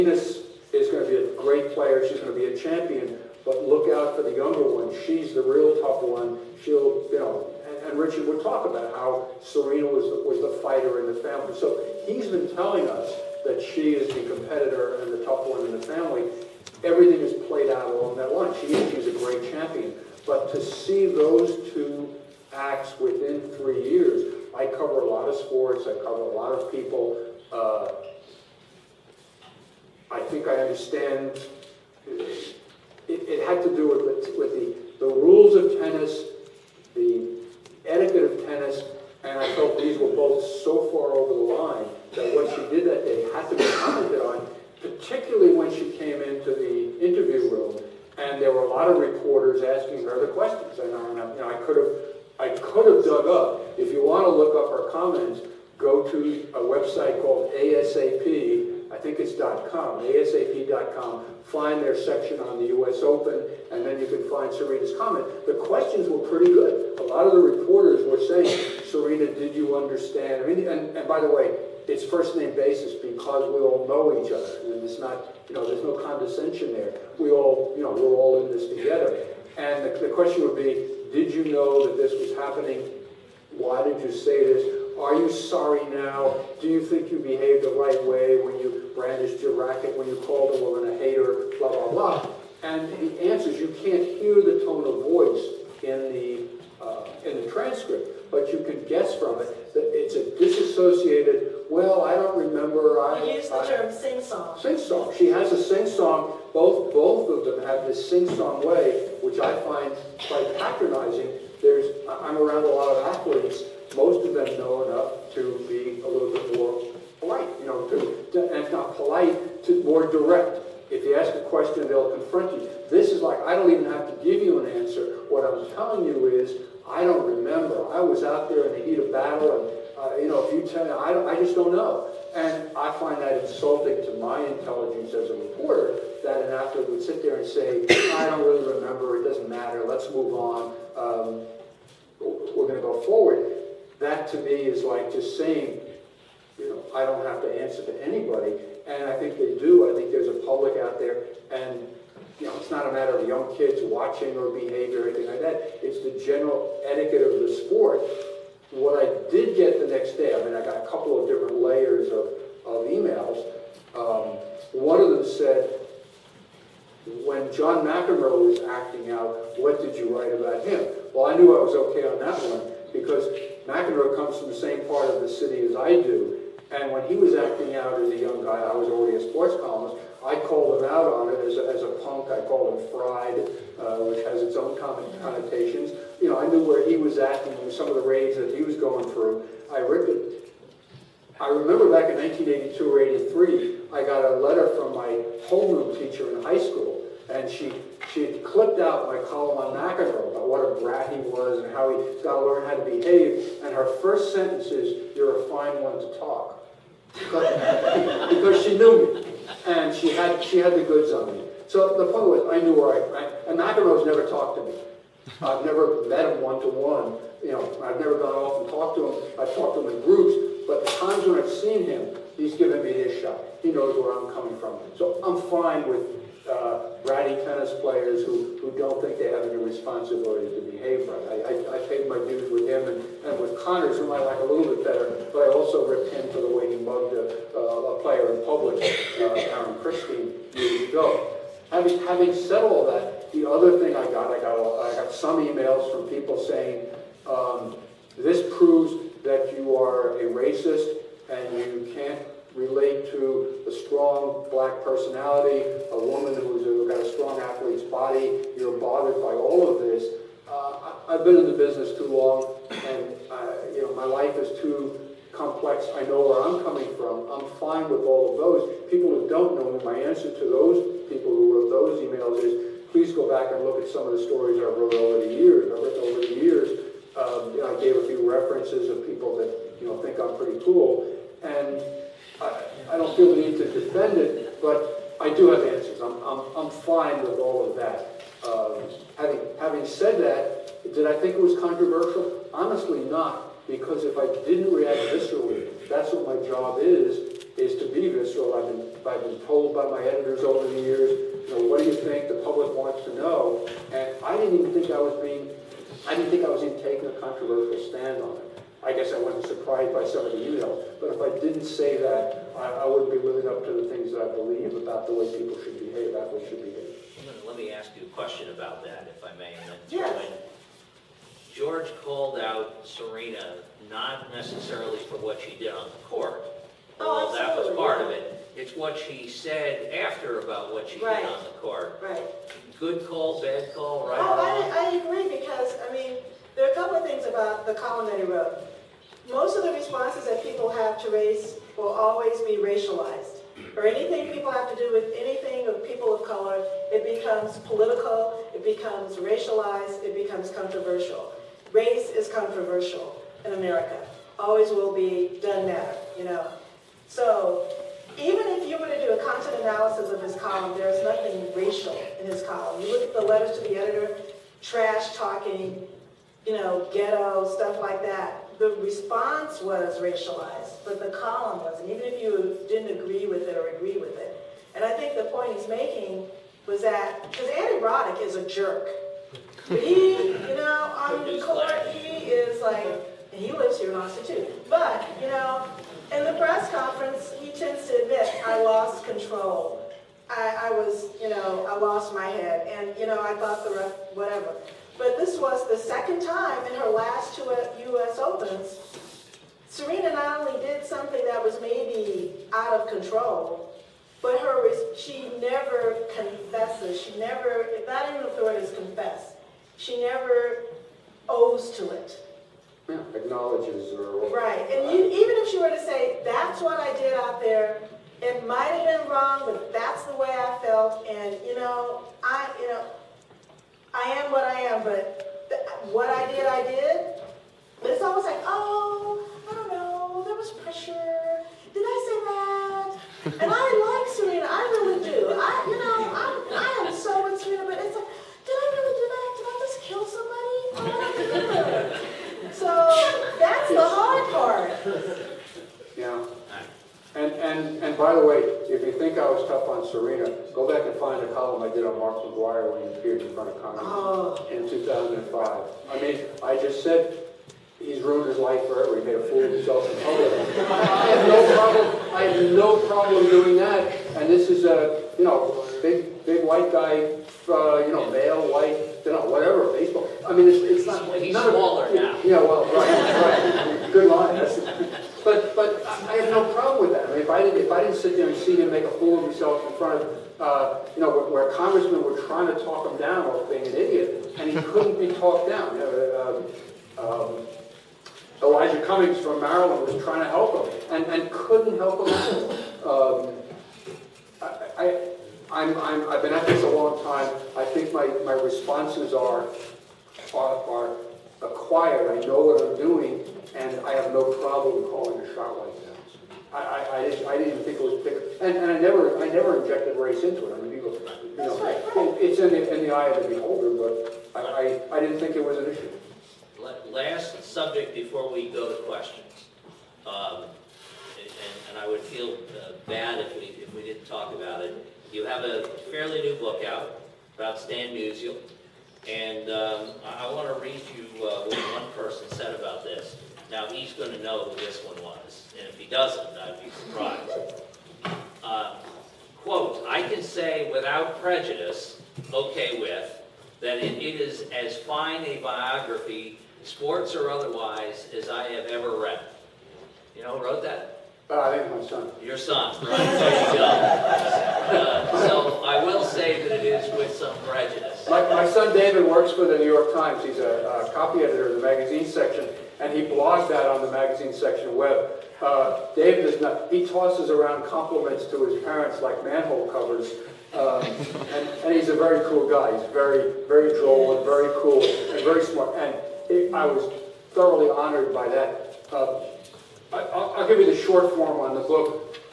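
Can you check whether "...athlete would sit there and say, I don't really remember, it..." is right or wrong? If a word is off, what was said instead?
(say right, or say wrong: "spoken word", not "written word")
right.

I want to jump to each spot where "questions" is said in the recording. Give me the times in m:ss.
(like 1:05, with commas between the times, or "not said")
0:50, 1:05, 1:20, 2:01, 5:18, 8:38.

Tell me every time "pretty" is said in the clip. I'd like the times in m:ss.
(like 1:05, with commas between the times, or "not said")
1:06, 4:40.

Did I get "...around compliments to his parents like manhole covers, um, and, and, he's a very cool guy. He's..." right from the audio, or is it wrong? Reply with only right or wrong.
right.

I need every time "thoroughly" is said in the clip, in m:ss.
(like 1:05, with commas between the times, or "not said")
9:37.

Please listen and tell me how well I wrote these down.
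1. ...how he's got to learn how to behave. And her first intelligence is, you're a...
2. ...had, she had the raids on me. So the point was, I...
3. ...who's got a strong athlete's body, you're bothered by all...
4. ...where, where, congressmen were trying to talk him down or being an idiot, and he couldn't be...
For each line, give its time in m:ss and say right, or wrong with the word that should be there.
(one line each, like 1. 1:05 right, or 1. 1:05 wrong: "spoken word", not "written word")
1. 3:21 wrong: "sentence", not "intelligence"
2. 3:30 wrong: "goods", not "raids"
3. 4:16 right
4. 8:01 right.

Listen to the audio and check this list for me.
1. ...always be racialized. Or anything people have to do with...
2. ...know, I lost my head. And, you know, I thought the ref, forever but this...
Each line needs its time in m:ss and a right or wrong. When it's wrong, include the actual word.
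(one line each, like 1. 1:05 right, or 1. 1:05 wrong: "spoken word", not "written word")
1. 5:41 right
2. 6:31 wrong: "whatever", not "forever".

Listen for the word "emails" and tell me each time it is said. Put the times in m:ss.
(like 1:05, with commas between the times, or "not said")
2:42, 4:05, 4:32, 5:10.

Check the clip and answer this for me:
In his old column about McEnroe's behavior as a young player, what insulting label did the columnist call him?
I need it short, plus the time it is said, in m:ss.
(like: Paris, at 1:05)
a punk, at 3:01.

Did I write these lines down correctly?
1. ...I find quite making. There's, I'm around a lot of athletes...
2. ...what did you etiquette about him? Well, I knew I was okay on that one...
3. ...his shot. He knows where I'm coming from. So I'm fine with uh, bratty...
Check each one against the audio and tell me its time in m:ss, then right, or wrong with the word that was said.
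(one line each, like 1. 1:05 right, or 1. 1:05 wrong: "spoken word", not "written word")
1. 1:49 wrong: "patronizing", not "making"
2. 2:49 wrong: "write", not "etiquette"
3. 3:42 right.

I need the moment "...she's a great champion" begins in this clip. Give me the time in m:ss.
0:18.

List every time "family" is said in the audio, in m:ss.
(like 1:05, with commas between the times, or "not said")
0:11, 0:15.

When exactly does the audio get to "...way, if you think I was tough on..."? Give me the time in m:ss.
7:28.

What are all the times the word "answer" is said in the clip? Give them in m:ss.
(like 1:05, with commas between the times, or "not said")
1:33, 2:04, 2:27, 4:30, 4:45.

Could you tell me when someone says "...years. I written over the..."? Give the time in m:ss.
4:35.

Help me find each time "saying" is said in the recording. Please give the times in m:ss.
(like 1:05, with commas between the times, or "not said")
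1:08, 2:25, 4:06.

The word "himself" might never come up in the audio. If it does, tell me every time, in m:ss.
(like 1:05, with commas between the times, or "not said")
7:39, 7:59.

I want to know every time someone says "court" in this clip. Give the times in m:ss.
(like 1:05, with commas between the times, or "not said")
5:26, 5:31, 6:21.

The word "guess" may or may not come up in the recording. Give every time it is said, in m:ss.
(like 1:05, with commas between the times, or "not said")
1:38, 5:08.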